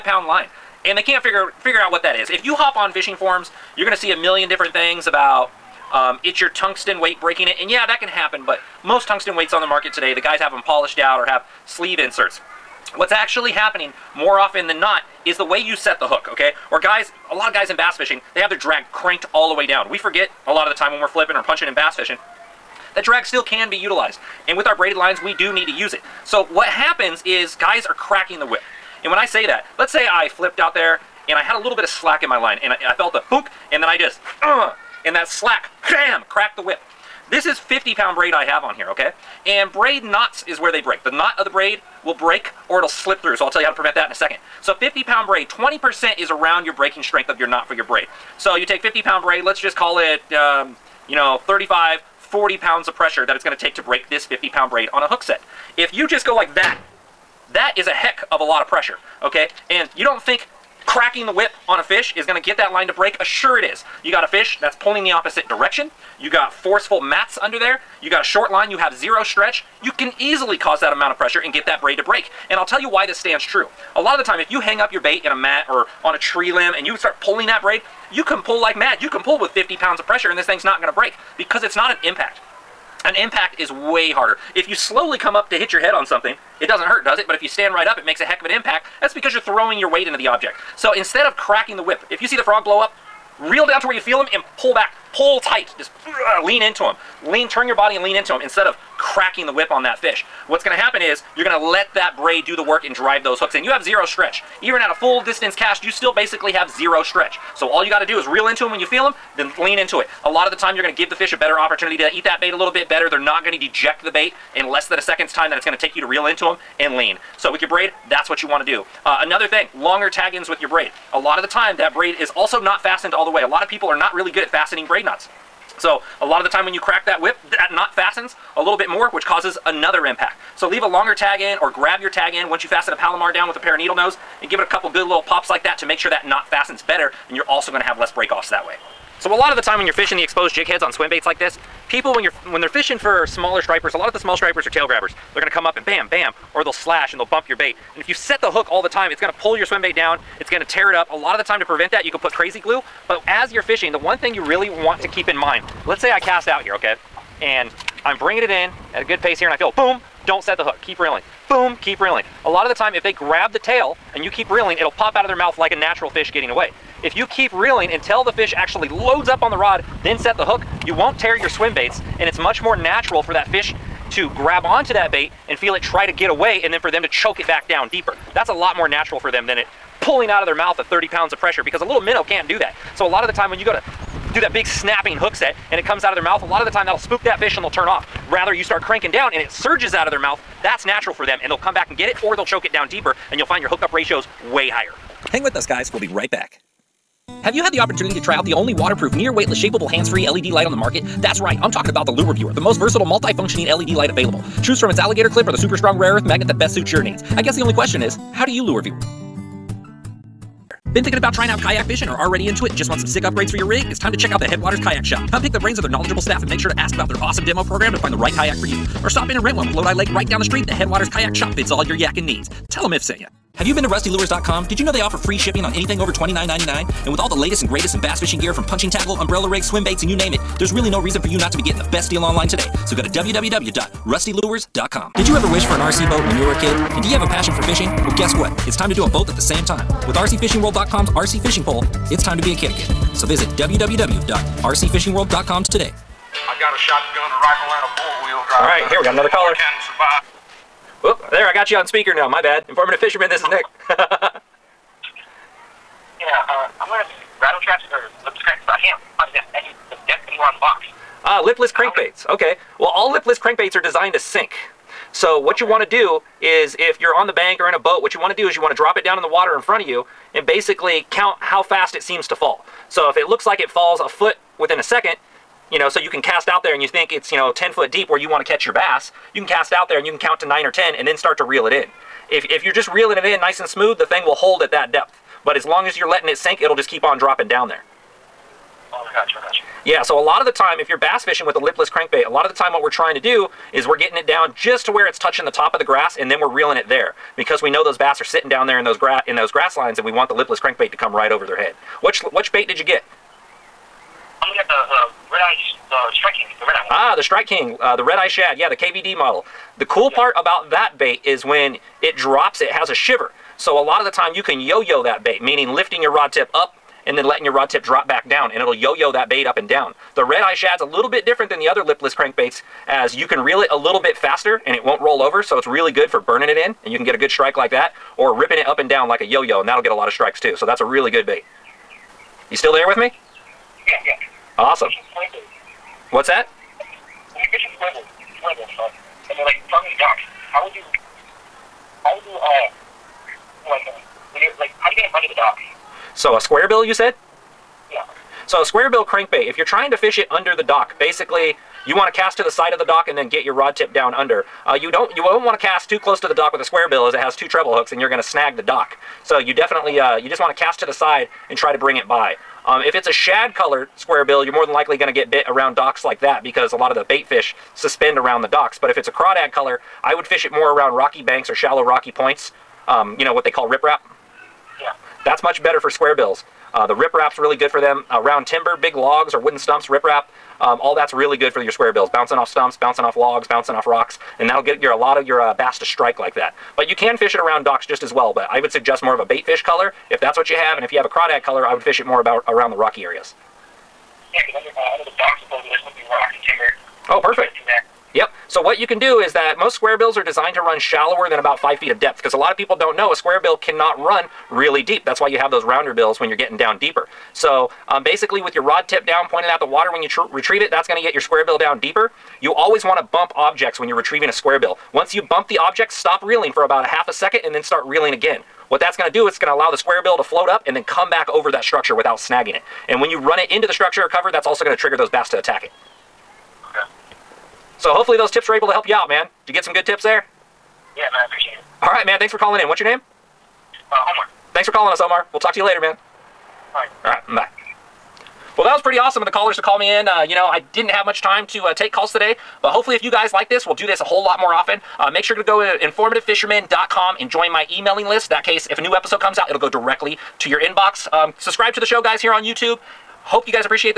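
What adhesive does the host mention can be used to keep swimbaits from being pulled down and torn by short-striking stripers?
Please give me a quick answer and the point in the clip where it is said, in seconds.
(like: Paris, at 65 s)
crazy glue, at 152 s.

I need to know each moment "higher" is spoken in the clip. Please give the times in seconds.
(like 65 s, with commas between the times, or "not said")
194 s.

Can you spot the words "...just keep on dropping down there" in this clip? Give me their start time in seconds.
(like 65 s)
286 s.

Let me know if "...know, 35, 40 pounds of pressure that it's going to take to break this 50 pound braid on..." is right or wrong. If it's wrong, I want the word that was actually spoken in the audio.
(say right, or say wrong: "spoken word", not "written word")
right.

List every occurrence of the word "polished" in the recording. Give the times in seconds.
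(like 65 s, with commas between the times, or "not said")
10 s.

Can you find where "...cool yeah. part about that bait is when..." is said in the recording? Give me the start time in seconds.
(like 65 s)
309 s.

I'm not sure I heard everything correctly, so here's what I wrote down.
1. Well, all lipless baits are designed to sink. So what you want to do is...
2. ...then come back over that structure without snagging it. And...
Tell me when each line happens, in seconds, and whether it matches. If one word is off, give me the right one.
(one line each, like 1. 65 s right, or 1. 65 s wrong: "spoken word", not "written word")
1. 262 s wrong: "crankbaits", not "baits"
2. 420 s right.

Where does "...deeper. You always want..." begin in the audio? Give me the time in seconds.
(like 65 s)
411 s.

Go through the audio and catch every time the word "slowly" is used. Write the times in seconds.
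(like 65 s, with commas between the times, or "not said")
84 s.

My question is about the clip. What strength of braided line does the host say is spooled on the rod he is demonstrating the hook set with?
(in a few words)
50 pound.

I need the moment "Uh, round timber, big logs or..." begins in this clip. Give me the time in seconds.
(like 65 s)
378 s.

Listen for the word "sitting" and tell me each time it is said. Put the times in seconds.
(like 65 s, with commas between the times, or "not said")
298 s.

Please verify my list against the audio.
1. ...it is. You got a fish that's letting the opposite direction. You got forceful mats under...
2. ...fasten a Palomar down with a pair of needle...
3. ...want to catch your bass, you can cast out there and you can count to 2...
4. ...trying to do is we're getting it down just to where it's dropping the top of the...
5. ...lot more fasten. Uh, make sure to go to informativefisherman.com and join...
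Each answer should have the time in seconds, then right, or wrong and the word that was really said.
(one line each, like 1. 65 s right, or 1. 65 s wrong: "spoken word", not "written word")
1. 63 s wrong: "pulling", not "letting"
2. 132 s right
3. 278 s wrong: "9", not "2"
4. 292 s wrong: "touching", not "dropping"
5. 444 s wrong: "often", not "fasten".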